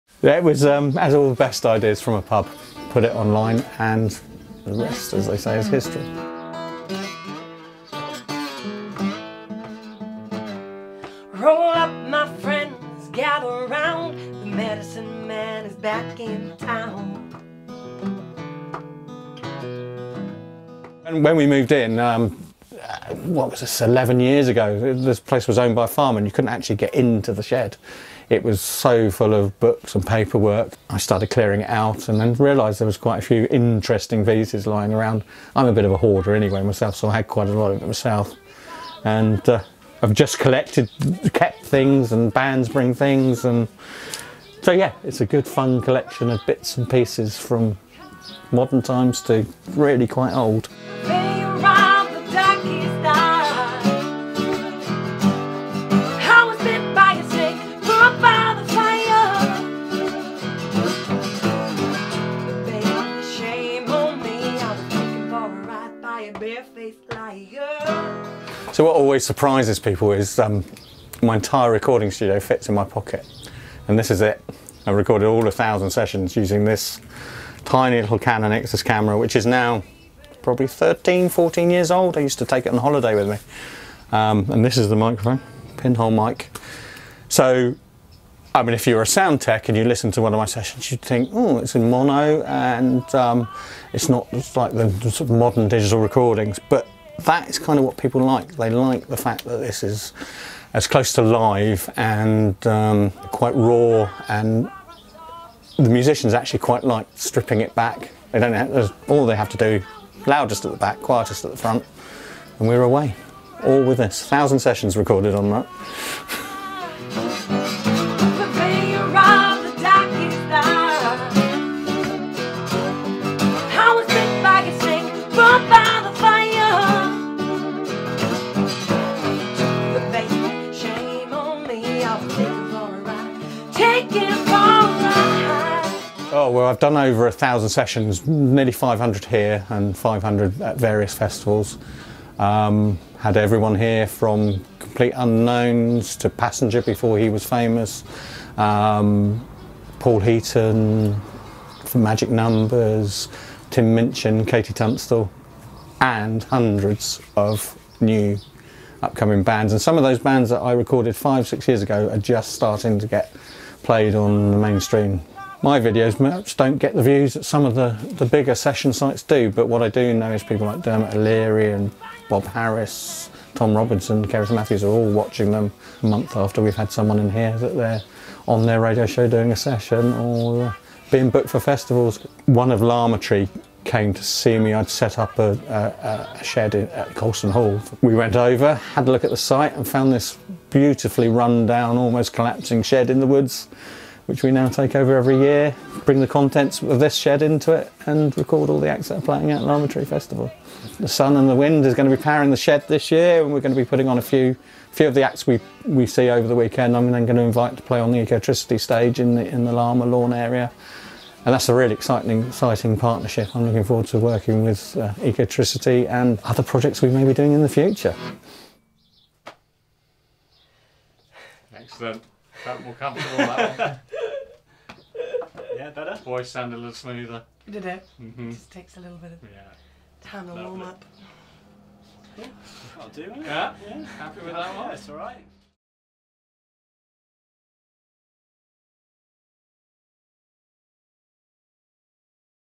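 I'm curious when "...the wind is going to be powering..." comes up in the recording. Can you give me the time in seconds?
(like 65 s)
201 s.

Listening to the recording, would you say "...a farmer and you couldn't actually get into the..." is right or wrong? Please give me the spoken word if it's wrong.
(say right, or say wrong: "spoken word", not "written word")
right.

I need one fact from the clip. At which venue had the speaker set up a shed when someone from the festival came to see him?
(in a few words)
Colston Hall.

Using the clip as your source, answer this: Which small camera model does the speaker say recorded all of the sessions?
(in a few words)
Canon Ixus.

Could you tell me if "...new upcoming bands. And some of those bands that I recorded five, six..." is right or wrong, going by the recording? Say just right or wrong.
right.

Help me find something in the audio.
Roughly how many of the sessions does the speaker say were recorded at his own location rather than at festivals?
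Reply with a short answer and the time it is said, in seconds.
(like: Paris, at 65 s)
nearly 500, at 138 s.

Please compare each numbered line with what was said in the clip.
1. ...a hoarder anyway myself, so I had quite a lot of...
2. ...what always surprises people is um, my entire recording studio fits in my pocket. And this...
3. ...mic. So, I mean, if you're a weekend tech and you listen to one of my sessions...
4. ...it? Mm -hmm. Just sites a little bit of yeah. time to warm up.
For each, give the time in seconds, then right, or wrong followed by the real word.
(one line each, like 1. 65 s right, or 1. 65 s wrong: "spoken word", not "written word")
1. 35 s right
2. 68 s right
3. 86 s wrong: "sound", not "weekend"
4. 227 s wrong: "takes", not "sites".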